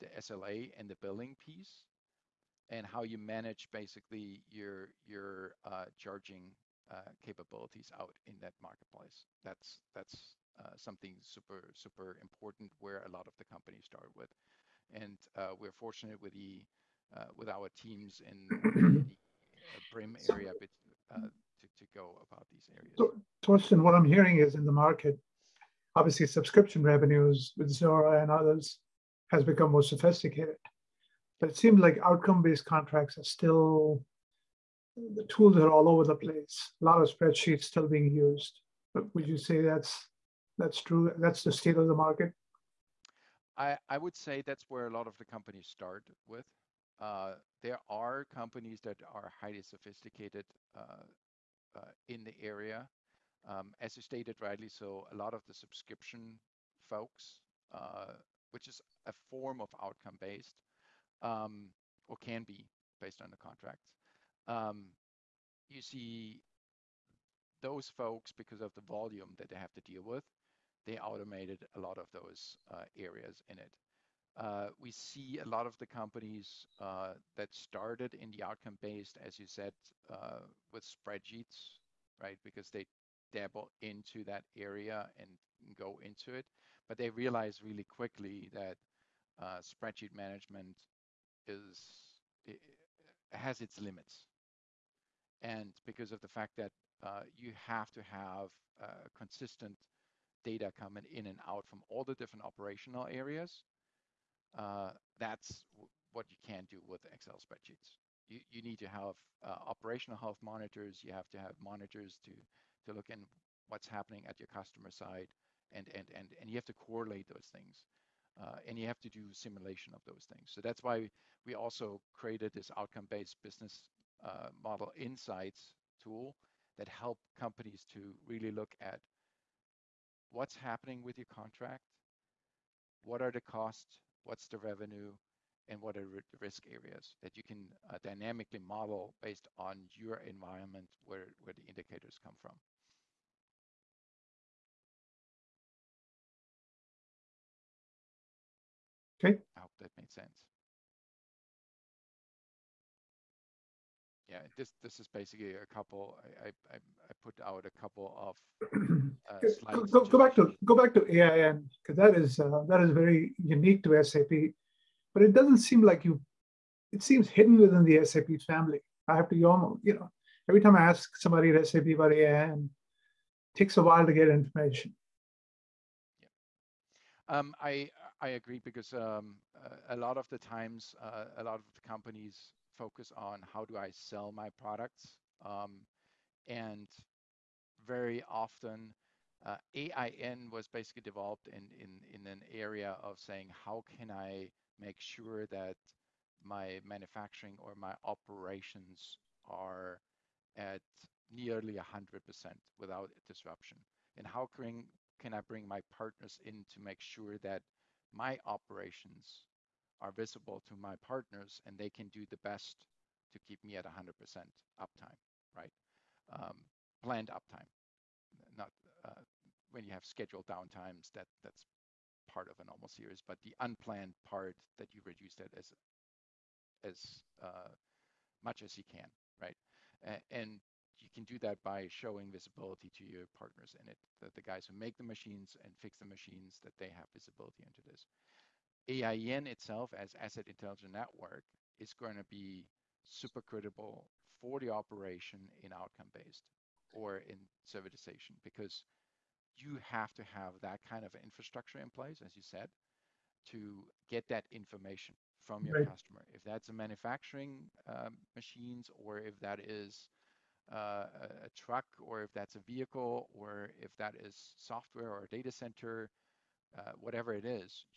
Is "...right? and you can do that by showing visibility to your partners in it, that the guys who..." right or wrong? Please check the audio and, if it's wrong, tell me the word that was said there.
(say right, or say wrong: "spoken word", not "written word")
right.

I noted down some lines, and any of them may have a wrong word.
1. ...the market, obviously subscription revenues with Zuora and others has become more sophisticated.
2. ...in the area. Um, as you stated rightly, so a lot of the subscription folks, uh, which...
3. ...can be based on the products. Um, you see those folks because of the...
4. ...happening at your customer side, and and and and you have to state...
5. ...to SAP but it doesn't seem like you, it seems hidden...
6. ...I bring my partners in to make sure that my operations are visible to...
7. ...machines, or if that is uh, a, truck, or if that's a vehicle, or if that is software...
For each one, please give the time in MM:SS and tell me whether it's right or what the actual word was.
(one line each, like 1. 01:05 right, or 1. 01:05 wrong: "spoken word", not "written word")
1. 00:24 right
2. 00:52 right
3. 01:02 wrong: "contracts", not "products"
4. 01:53 wrong: "correlate", not "state"
5. 02:43 right
6. 03:25 right
7. 04:18 right.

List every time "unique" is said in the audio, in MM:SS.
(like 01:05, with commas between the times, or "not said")
02:43.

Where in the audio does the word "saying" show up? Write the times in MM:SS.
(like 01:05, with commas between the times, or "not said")
03:13.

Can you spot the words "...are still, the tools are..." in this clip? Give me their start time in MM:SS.
00:33.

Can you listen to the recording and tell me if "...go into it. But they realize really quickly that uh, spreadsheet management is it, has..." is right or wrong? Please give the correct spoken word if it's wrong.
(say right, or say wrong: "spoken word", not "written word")
right.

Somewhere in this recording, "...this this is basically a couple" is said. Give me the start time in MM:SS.
02:34.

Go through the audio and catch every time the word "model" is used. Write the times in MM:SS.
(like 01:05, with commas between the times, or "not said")
02:04, 02:18.